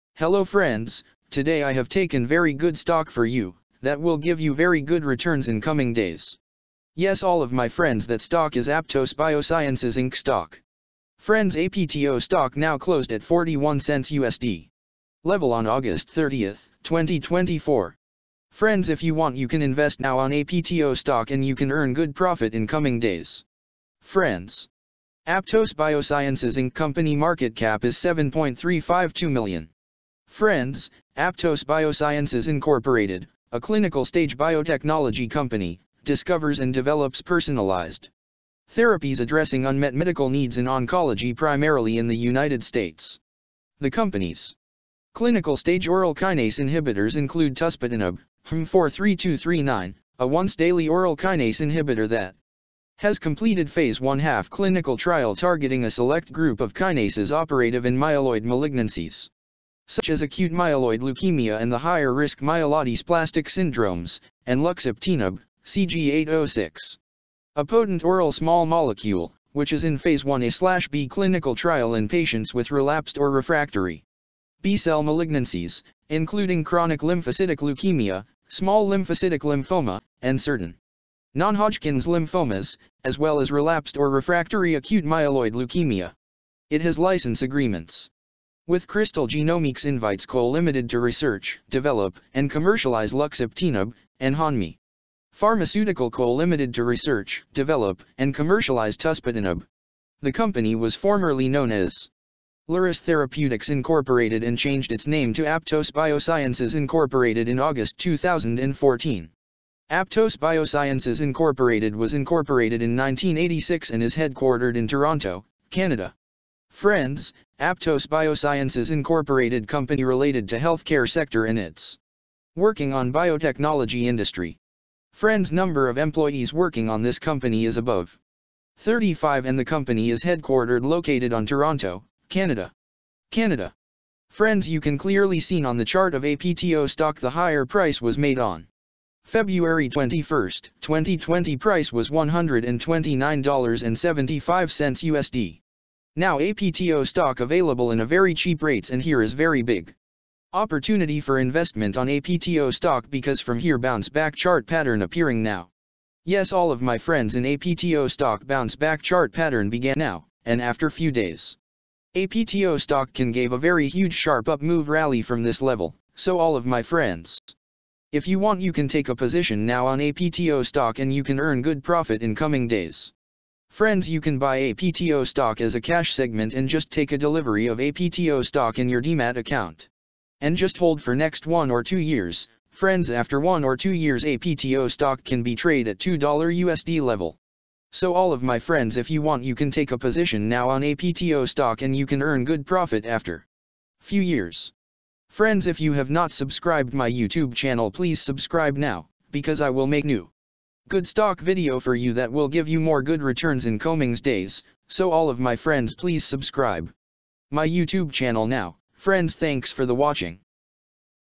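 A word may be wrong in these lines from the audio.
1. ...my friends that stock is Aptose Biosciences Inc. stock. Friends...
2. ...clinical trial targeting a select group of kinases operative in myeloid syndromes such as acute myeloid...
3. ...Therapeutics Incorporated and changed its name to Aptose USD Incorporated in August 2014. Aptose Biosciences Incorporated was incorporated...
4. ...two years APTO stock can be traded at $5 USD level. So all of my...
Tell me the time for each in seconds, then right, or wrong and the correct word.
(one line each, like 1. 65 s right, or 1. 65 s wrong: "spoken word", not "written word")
1. 7 s right
2. 54 s wrong: "malignancies", not "syndromes"
3. 102 s wrong: "Biosciences", not "USD"
4. 183 s wrong: "2", not "5".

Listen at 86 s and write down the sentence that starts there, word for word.
It has license agreements with Crystal Genomics invites Co Limited to research, develop, and commercialize luxeptinib and Hanmi.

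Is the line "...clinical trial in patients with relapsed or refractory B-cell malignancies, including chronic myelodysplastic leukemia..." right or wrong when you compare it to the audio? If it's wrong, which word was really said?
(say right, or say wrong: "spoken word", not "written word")
wrong: "lymphocytic", not "myelodysplastic".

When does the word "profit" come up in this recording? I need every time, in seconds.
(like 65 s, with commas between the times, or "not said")
22 s, 171 s, 192 s.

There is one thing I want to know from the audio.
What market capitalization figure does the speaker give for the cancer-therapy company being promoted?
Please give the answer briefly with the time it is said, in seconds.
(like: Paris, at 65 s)
7.352 million, at 27 s.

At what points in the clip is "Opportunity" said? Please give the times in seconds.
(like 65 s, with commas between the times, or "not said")
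150 s.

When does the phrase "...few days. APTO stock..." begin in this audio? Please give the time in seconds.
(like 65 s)
160 s.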